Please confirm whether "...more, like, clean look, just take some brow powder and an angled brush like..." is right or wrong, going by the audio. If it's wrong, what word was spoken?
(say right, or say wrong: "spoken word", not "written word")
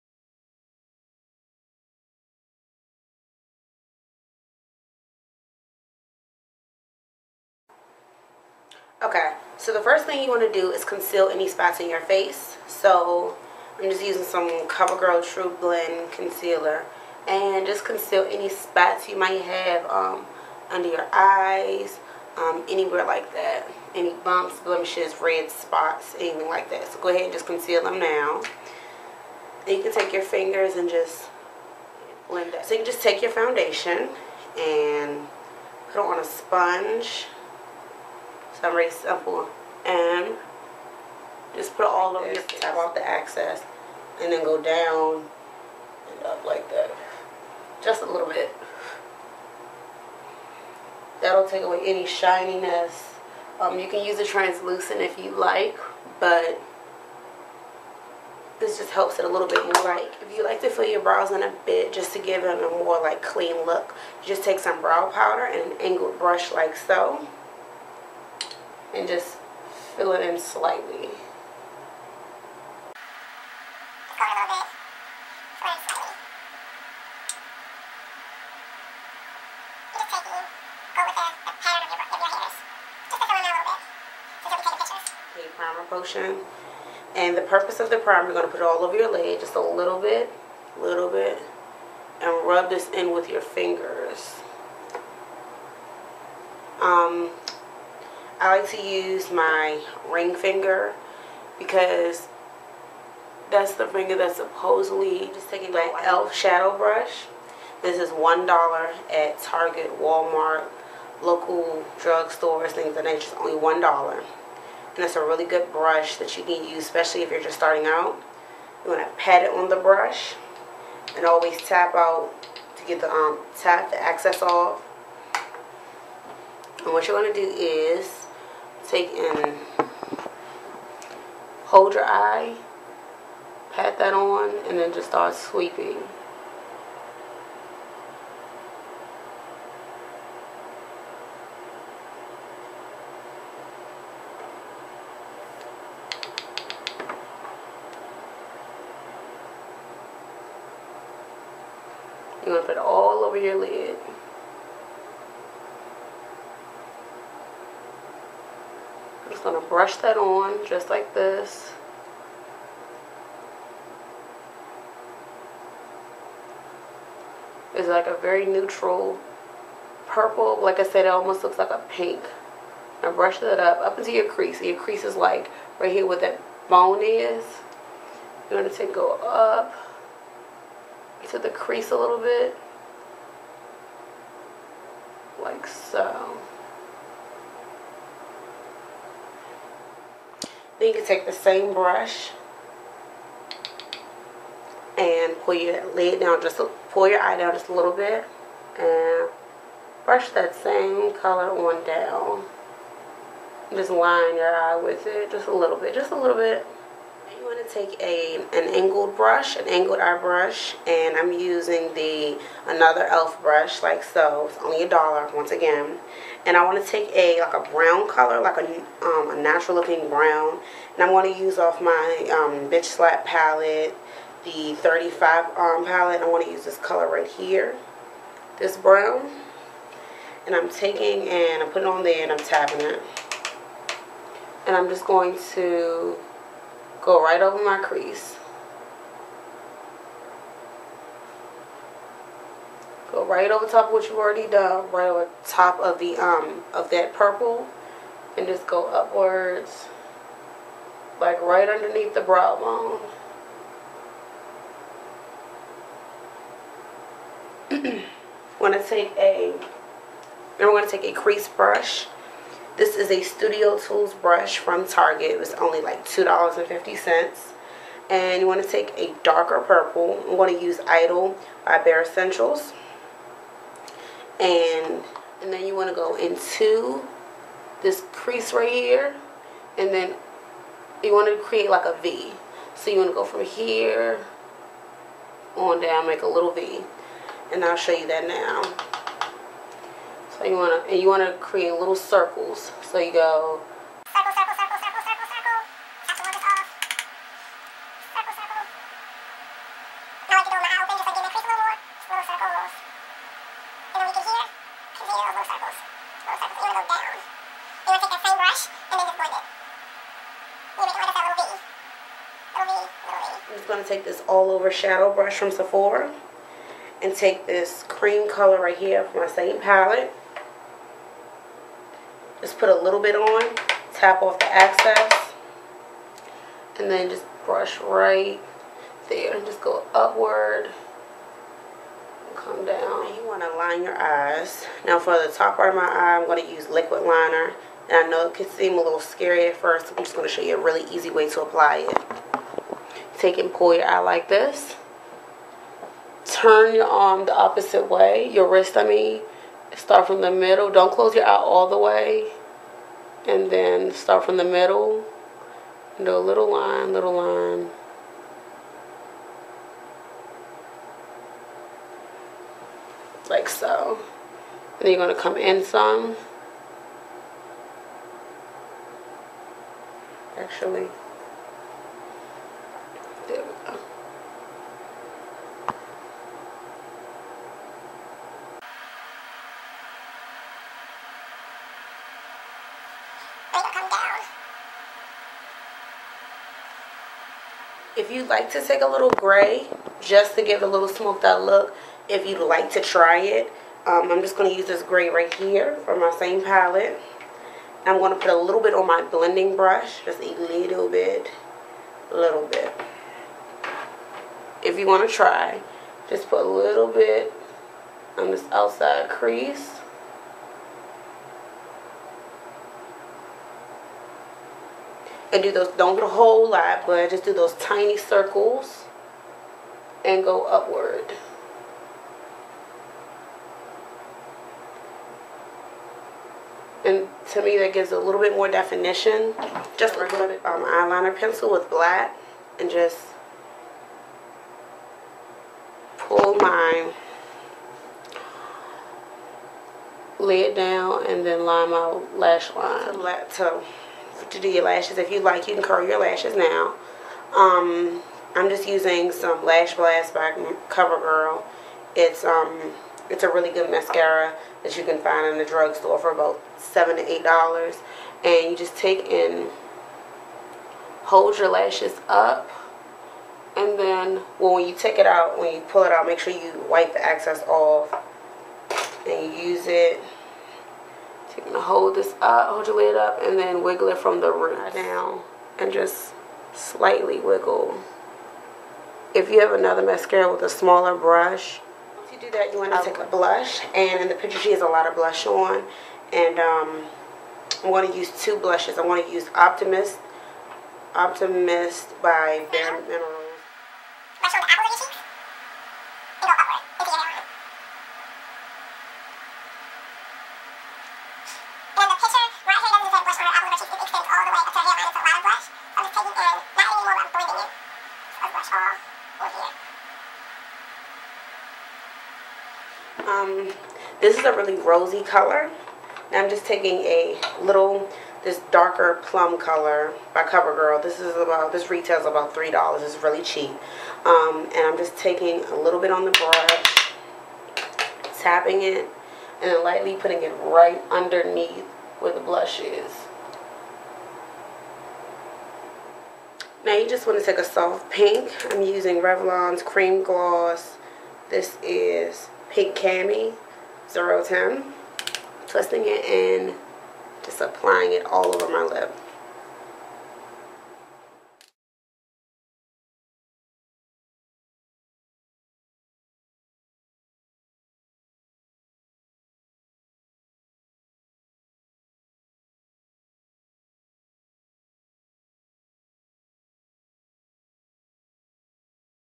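right.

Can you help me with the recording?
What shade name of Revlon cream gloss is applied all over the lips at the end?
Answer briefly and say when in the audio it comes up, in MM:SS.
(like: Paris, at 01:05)
Pink Cami, at 09:02.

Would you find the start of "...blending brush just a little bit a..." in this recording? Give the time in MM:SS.
06:39.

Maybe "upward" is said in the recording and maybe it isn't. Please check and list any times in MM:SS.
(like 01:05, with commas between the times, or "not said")
04:08, 05:29, 07:00.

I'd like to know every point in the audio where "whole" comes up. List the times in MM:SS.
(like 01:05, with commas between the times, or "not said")
06:56.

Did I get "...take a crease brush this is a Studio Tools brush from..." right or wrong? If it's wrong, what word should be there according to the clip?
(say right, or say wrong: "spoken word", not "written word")
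right.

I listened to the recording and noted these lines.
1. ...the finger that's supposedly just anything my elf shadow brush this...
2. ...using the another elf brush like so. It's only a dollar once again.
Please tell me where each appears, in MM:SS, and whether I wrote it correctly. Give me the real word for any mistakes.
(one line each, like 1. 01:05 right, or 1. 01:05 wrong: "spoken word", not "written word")
1. 01:43 wrong: "taking", not "anything"
2. 03:31 right.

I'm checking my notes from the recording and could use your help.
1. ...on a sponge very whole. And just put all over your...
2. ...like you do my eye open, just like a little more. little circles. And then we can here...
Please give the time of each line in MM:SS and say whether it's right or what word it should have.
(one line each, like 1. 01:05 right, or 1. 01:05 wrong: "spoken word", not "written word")
1. 00:36 wrong: "simple", not "whole"
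2. 05:00 right.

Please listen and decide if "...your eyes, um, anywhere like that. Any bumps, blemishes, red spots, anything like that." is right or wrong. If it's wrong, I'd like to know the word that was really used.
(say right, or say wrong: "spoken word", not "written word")
right.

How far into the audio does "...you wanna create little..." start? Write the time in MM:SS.
04:50.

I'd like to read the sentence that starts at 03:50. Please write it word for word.
And I'm taking and I'm putting on there and I'm tapping it.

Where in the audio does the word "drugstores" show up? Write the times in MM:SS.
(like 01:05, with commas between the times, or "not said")
01:51, 07:35.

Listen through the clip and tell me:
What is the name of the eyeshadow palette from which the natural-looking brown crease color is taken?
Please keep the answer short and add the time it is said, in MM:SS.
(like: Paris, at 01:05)
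Bitch Slap, at 03:42.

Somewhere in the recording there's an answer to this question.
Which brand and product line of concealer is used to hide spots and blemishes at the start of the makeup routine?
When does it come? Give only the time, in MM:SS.
00:14.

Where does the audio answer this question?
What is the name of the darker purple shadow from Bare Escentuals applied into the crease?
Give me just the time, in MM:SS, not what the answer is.
04:30.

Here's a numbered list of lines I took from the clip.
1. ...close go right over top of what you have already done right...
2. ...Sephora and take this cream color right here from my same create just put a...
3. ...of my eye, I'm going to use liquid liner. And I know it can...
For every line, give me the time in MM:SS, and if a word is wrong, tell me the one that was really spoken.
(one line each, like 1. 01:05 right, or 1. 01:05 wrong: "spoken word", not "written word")
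1. 03:57 wrong: "crease", not "close"
2. 05:15 wrong: "palette", not "create"
3. 05:35 right.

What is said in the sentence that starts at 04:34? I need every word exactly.
And, and then you want to go into this crease right here.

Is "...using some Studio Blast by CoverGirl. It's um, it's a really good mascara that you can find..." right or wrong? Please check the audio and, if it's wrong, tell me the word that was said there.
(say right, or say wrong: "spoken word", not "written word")
wrong: "Lash", not "Studio".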